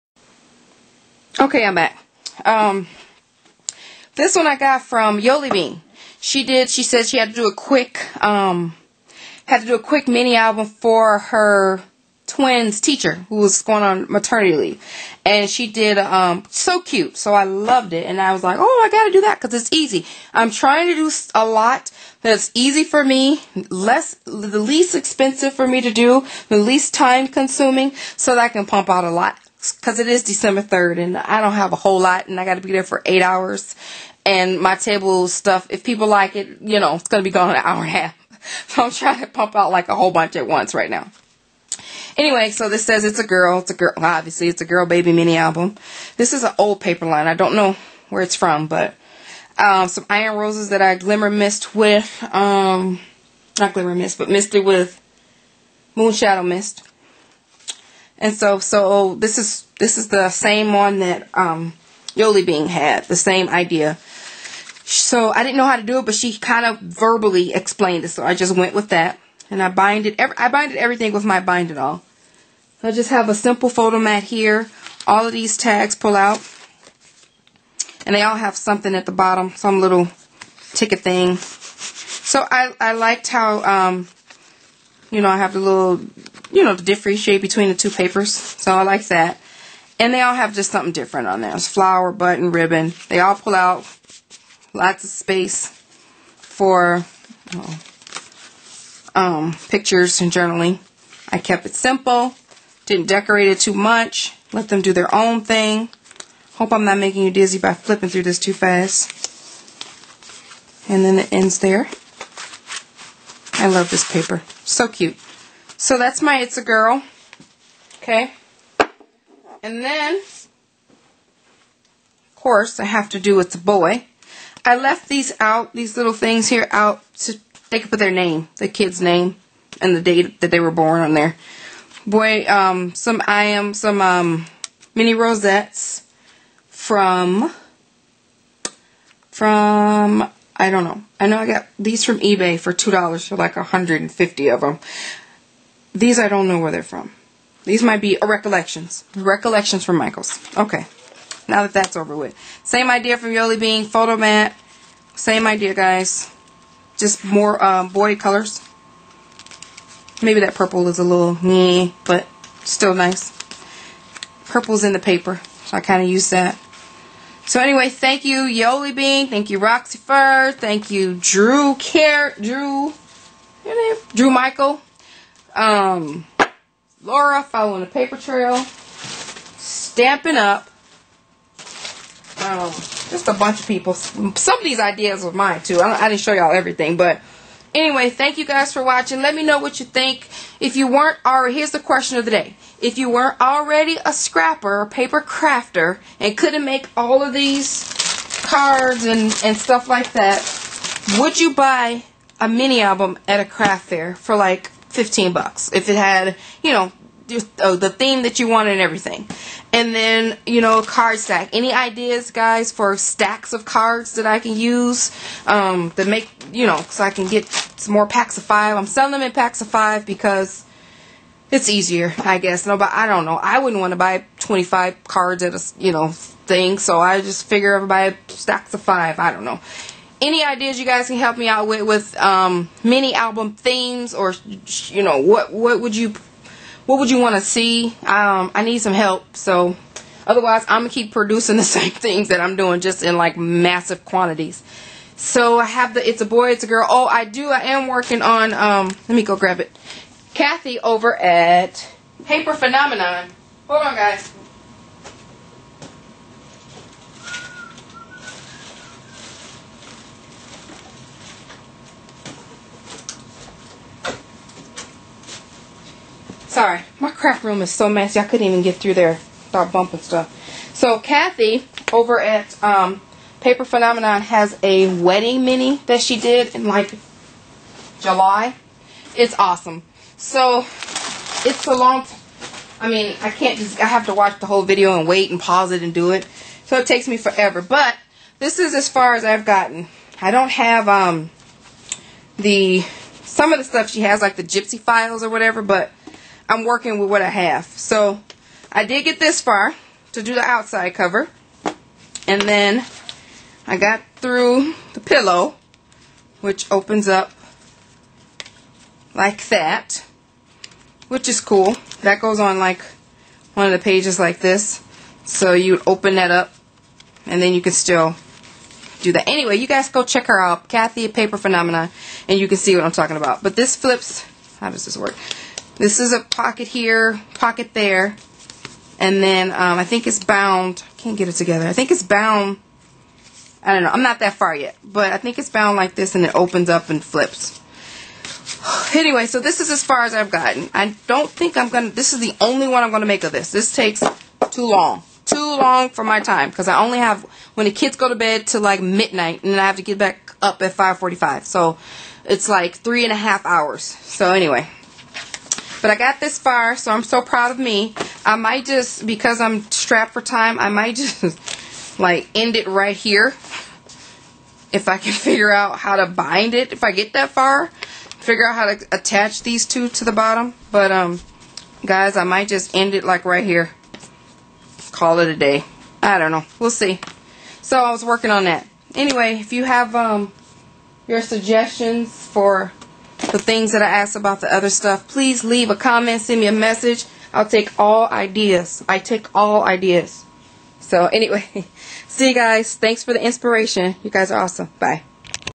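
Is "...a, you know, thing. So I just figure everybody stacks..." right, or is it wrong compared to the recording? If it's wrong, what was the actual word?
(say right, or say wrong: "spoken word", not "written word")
right.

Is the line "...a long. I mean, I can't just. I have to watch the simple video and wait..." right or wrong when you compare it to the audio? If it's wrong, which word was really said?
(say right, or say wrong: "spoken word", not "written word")
wrong: "whole", not "simple".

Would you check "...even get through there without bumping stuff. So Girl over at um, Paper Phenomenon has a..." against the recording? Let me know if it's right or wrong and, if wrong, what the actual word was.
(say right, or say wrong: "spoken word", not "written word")
wrong: "Kathy", not "Girl".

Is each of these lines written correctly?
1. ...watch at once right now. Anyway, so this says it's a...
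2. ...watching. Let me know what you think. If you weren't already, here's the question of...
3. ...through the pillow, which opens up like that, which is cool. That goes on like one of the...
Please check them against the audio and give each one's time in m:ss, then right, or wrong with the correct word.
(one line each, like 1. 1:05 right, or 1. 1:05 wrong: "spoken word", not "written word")
1. 0:40 wrong: "bunch", not "watch"
2. 3:08 right
3. 5:04 right.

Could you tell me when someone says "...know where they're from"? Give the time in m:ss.
2:26.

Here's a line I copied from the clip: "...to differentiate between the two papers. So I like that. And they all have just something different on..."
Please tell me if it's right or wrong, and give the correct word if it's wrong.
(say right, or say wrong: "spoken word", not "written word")
right.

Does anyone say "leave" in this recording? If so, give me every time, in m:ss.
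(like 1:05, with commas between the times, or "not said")
0:14, 6:25.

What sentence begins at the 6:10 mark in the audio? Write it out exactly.
But um, guys, I might just end it like right here.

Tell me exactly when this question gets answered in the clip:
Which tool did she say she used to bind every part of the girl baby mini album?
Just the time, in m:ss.
1:11.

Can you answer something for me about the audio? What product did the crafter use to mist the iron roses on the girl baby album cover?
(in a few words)
Moon Shadow Mist.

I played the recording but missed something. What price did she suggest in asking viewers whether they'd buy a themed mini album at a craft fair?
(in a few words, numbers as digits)
15 bucks.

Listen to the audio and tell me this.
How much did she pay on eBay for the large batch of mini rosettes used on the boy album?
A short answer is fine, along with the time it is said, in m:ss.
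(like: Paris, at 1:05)
$2, at 2:22.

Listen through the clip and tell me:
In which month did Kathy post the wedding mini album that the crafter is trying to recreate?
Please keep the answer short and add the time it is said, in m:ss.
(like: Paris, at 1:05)
July, at 4:37.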